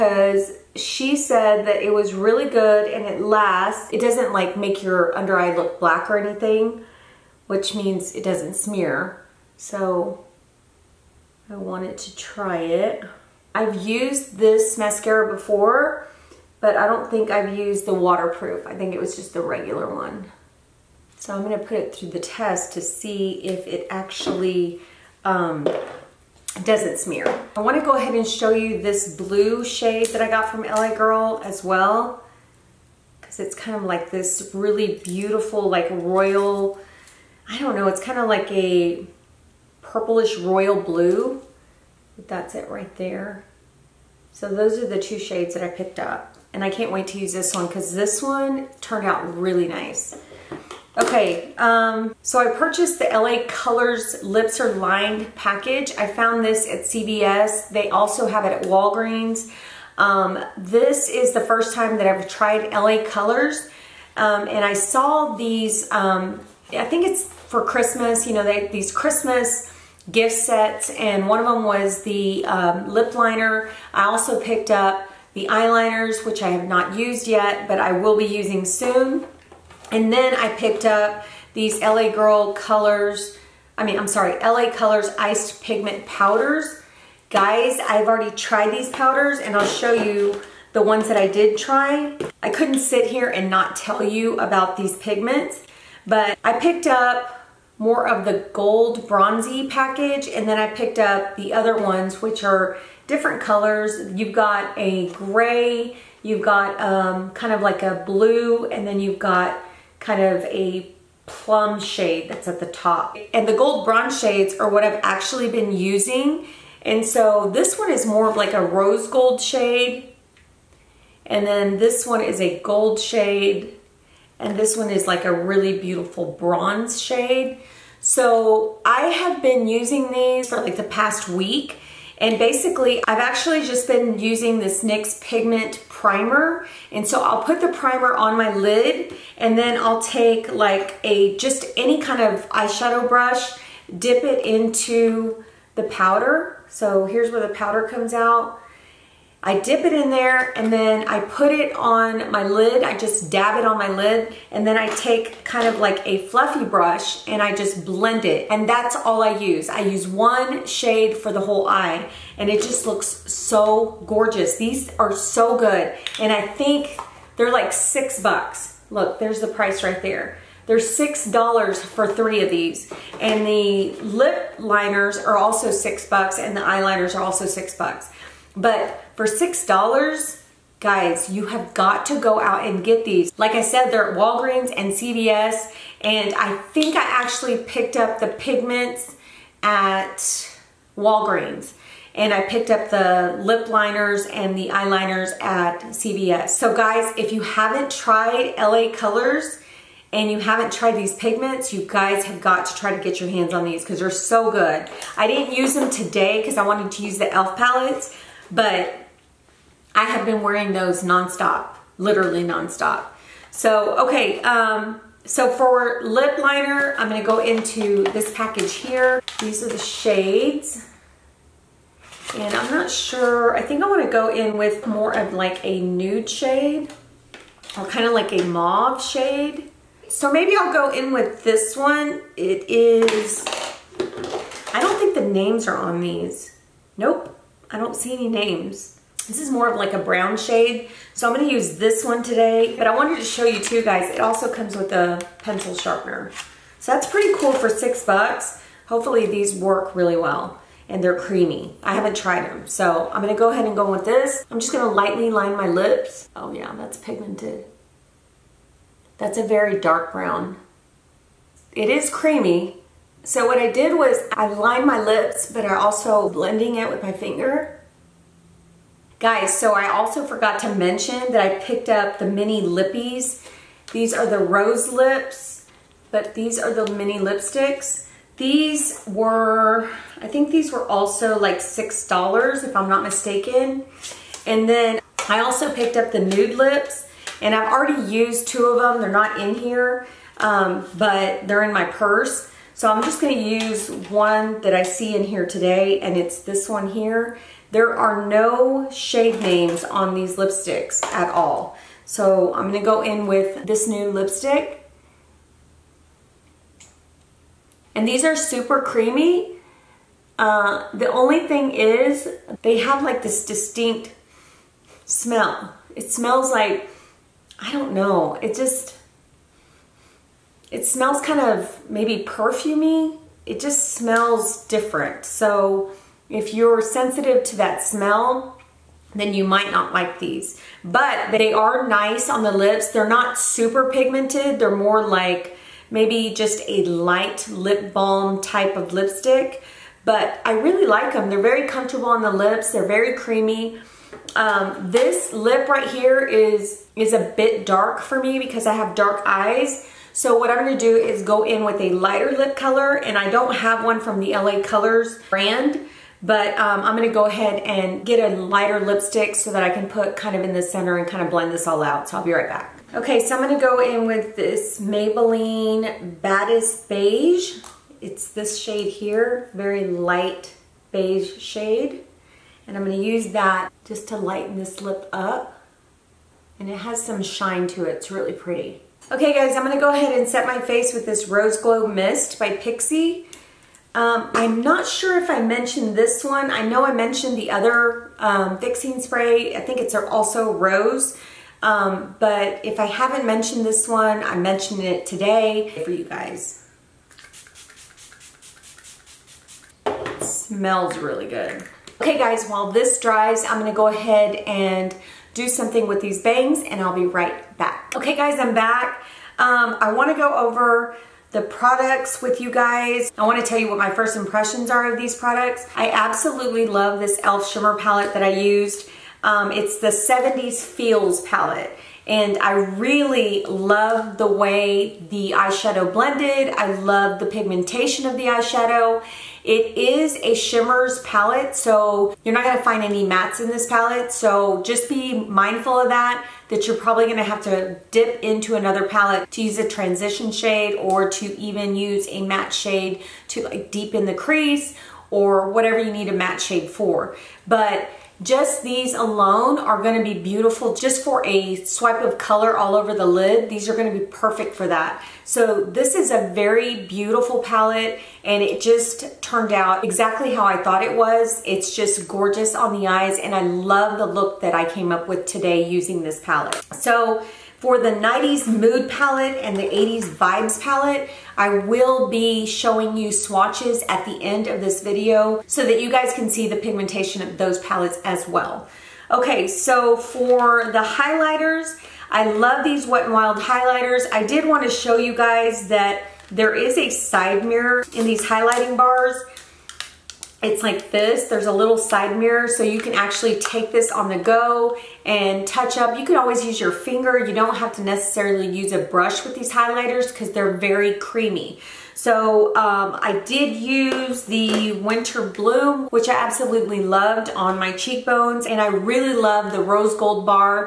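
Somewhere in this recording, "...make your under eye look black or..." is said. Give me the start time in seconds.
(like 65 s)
4 s.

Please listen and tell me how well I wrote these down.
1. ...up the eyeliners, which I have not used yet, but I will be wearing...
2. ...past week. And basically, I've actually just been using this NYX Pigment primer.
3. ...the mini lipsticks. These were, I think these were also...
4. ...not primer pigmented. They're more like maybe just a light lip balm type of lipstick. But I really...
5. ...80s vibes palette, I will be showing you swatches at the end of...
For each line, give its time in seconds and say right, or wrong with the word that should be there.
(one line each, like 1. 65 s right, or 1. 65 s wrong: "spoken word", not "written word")
1. 74 s wrong: "using", not "wearing"
2. 130 s right
3. 276 s right
4. 333 s wrong: "super", not "primer"
5. 469 s right.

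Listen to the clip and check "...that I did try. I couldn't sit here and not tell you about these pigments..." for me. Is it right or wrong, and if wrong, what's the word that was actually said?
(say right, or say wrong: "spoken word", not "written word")
right.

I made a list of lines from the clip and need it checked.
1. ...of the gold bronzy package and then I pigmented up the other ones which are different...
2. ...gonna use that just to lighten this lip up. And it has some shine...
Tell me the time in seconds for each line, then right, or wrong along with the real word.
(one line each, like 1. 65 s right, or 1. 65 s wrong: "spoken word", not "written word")
1. 98 s wrong: "picked", not "pigmented"
2. 372 s right.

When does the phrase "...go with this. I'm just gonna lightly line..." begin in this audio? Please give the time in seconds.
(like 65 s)
253 s.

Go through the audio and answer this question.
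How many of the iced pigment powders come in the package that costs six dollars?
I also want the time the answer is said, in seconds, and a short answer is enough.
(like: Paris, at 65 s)
3, at 172 s.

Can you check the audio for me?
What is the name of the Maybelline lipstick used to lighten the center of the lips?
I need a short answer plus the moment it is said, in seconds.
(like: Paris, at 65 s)
Baddest Beige, at 366 s.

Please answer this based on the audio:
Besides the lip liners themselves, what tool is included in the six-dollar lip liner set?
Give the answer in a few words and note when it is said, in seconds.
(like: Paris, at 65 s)
pencil sharpener, at 245 s.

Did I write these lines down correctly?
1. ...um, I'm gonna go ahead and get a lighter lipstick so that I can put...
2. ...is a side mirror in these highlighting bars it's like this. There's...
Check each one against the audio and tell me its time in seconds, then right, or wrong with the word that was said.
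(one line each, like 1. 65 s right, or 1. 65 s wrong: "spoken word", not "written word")
1. 356 s right
2. 486 s right.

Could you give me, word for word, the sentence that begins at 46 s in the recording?
And I can't wait to use this one because this one turned out really nice.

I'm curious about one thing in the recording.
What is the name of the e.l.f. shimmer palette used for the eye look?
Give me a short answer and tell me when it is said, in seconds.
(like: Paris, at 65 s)
70s Feels, at 419 s.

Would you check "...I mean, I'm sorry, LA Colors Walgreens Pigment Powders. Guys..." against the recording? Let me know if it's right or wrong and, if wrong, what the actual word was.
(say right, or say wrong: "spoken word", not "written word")
wrong: "Iced", not "Walgreens".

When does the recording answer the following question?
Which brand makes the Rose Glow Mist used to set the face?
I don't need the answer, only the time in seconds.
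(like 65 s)
382 s.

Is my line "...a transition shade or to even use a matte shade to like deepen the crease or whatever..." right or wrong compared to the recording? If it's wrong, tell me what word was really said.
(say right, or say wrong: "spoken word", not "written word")
right.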